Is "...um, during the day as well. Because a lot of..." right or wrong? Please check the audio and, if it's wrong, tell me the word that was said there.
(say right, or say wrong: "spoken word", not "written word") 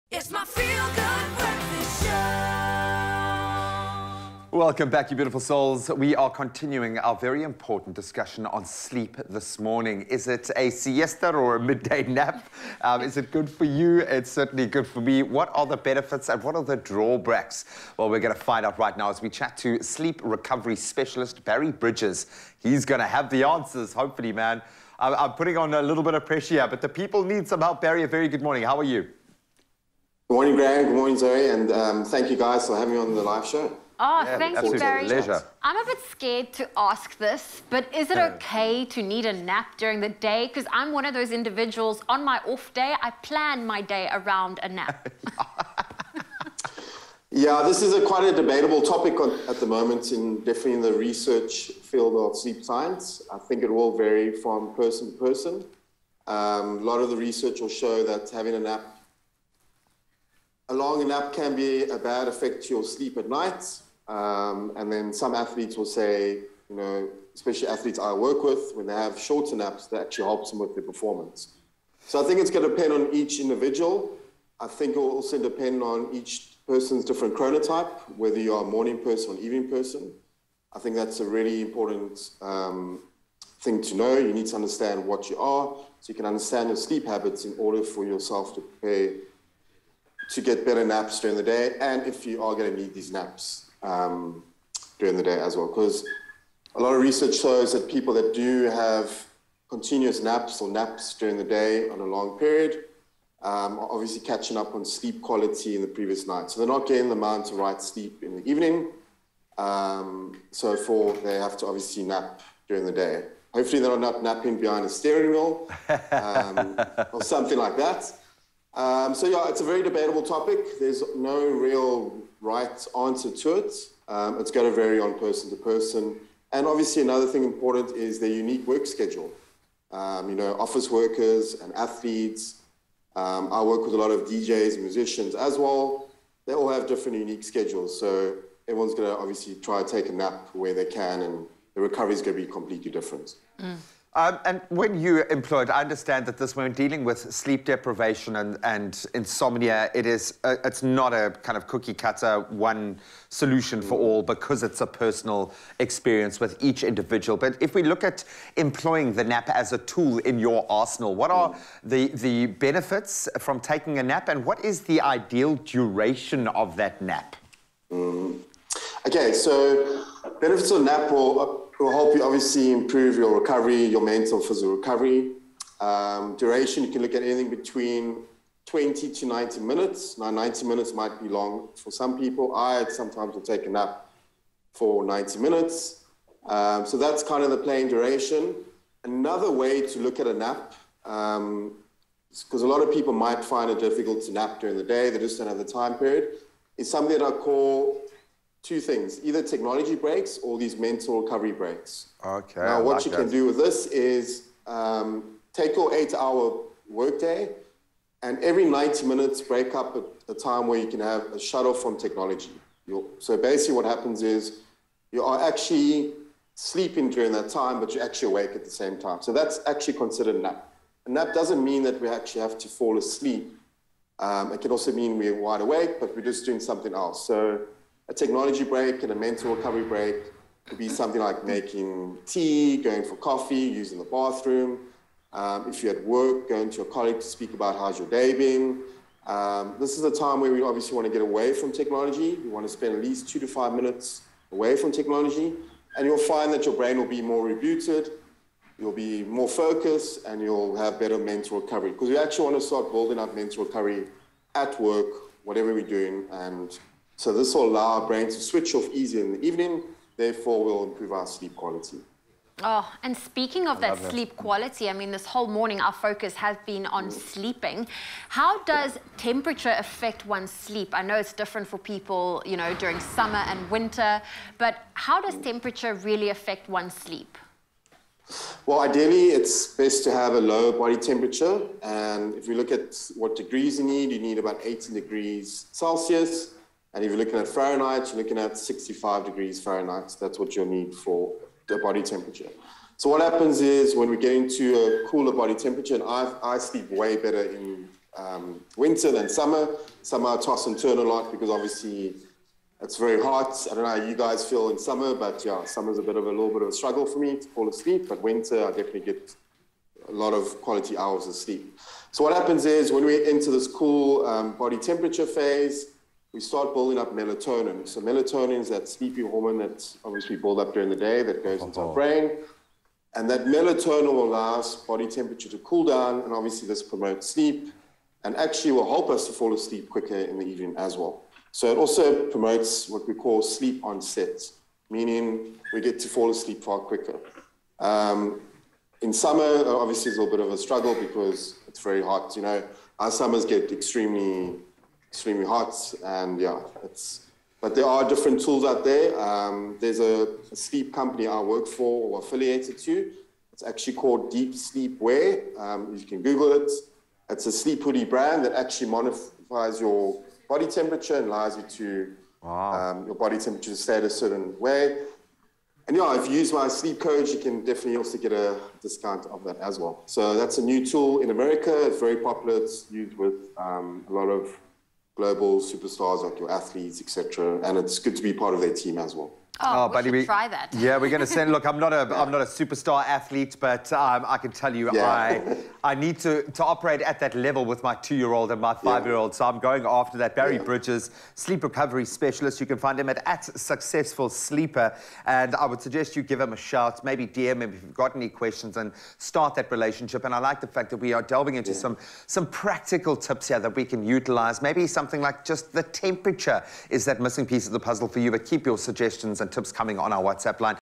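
right.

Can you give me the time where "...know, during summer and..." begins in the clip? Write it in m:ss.
4:32.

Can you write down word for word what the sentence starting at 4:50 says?
That's what you'll need for the body temperature.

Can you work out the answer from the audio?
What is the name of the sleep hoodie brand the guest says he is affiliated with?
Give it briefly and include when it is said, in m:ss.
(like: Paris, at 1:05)
Deep Sleep Wear, at 5:54.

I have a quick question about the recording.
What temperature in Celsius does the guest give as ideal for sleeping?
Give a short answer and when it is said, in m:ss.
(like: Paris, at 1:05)
18 degrees Celsius, at 4:44.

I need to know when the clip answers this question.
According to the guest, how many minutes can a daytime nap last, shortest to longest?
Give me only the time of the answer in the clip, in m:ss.
2:58.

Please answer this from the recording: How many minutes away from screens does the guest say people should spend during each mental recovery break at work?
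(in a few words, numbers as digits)
2 to 5 minutes.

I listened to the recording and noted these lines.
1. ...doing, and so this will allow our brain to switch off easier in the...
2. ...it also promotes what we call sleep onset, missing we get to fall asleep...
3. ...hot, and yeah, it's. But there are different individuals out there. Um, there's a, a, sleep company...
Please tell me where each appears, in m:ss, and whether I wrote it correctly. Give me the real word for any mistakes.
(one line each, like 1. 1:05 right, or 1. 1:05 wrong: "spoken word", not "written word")
1. 4:15 right
2. 5:31 wrong: "meaning", not "missing"
3. 5:45 wrong: "tools", not "individuals".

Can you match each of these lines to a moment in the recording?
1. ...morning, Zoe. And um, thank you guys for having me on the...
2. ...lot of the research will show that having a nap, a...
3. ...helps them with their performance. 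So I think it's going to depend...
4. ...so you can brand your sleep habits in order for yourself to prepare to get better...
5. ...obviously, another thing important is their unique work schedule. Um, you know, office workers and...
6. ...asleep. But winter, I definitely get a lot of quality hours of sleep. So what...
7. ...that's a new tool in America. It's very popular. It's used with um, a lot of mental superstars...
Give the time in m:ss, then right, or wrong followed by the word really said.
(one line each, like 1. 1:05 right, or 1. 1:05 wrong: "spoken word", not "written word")
1. 0:30 right
2. 0:56 right
3. 1:10 right
4. 1:25 wrong: "understand", not "brand"
5. 2:06 right
6. 5:07 right
7. 6:10 wrong: "global", not "mental".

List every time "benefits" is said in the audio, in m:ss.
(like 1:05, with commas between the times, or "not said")
0:15, 2:42, 2:50.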